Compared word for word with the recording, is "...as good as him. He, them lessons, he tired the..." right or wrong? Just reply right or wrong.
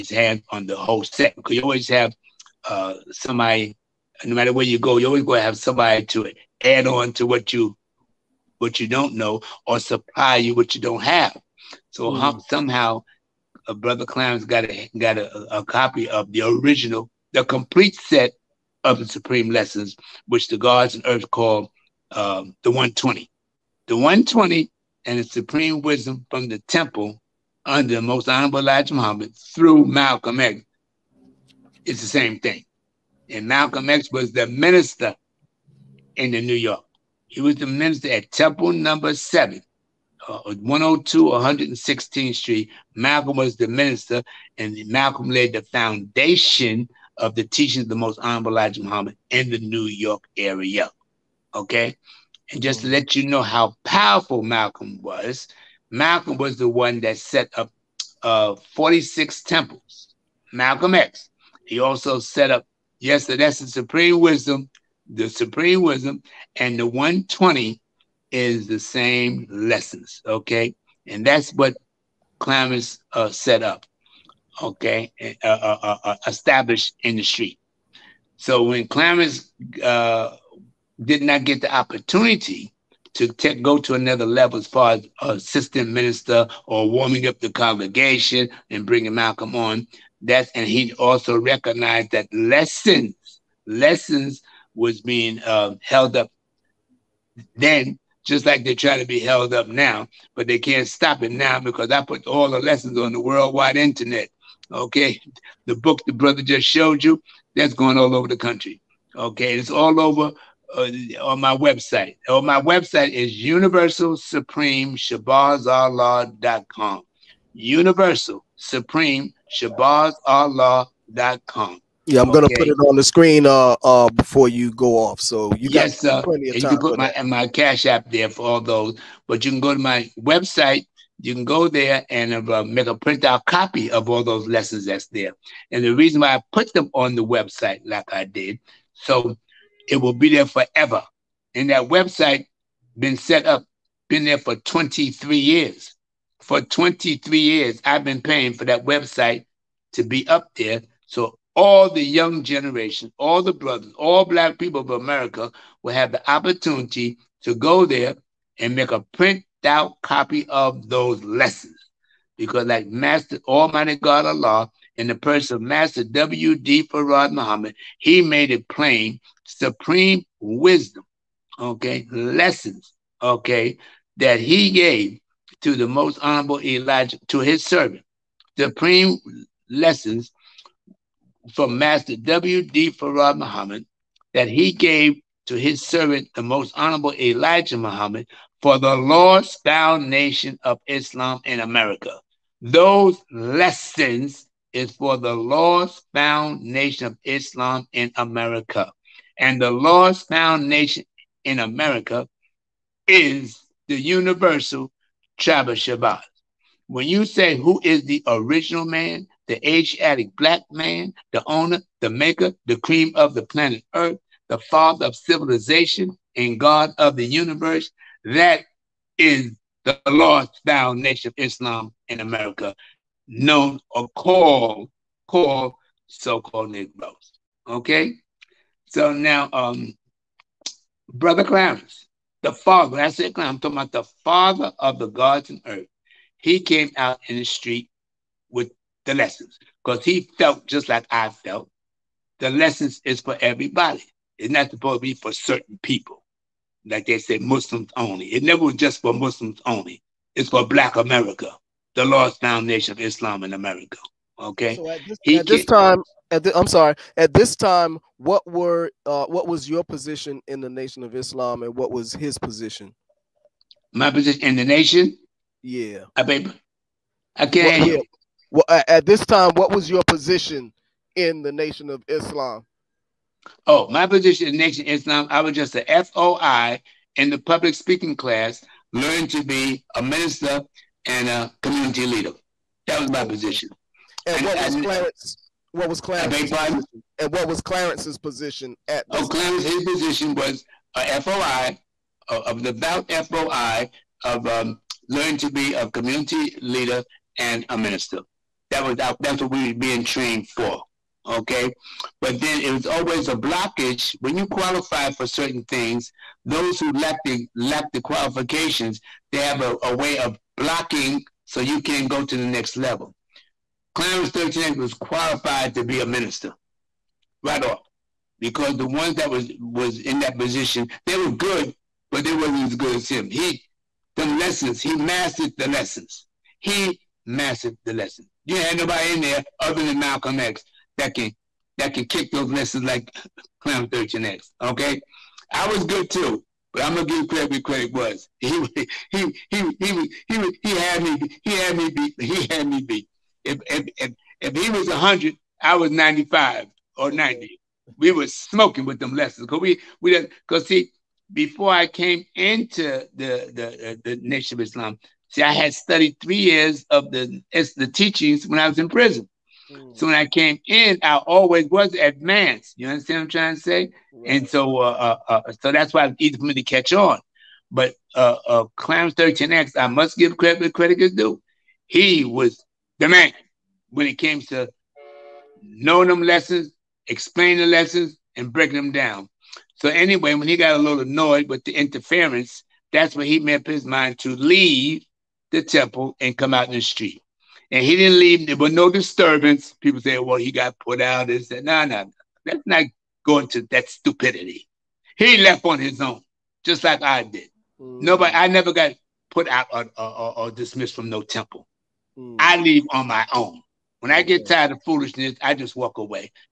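wrong.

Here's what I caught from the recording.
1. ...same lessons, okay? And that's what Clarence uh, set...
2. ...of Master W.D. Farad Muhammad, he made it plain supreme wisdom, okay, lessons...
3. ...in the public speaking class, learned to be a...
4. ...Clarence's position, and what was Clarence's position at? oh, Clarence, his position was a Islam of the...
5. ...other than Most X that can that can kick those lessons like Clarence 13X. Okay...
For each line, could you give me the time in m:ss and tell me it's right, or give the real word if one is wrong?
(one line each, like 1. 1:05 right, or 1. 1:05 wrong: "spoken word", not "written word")
1. 1:08 right
2. 2:45 right
3. 4:37 right
4. 4:45 wrong: "FOI", not "Islam"
5. 5:29 wrong: "Malcolm", not "Most".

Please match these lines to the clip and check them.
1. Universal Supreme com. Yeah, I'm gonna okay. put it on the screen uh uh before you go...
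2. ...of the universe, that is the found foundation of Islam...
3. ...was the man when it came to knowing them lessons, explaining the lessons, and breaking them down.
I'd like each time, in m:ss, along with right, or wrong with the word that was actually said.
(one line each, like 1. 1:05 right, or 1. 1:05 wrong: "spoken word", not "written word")
1. 1:57 right
2. 3:36 right
3. 6:12 right.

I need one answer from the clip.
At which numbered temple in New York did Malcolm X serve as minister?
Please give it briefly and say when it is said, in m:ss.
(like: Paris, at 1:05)
Temple Number Seven, at 0:38.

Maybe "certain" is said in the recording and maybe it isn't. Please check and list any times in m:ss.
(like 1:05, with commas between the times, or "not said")
4:05, 5:05.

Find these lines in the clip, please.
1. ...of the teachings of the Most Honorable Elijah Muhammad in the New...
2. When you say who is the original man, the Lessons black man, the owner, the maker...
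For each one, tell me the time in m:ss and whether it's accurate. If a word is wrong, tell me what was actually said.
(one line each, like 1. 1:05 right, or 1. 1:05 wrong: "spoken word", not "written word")
1. 0:47 right
2. 3:26 wrong: "Asiatic", not "Lessons".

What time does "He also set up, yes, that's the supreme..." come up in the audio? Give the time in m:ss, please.
1:01.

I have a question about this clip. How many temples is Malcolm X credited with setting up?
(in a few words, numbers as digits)
46.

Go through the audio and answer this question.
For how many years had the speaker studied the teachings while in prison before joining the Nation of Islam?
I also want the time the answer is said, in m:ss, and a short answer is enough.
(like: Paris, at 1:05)
3 years, at 5:56.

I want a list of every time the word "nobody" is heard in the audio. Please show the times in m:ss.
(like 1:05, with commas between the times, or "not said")
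5:28, 6:38.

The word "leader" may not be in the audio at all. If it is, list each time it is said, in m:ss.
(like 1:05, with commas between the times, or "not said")
4:42, 4:56.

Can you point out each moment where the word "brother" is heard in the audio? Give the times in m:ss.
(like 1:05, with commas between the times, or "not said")
0:13, 1:46, 2:33, 3:51.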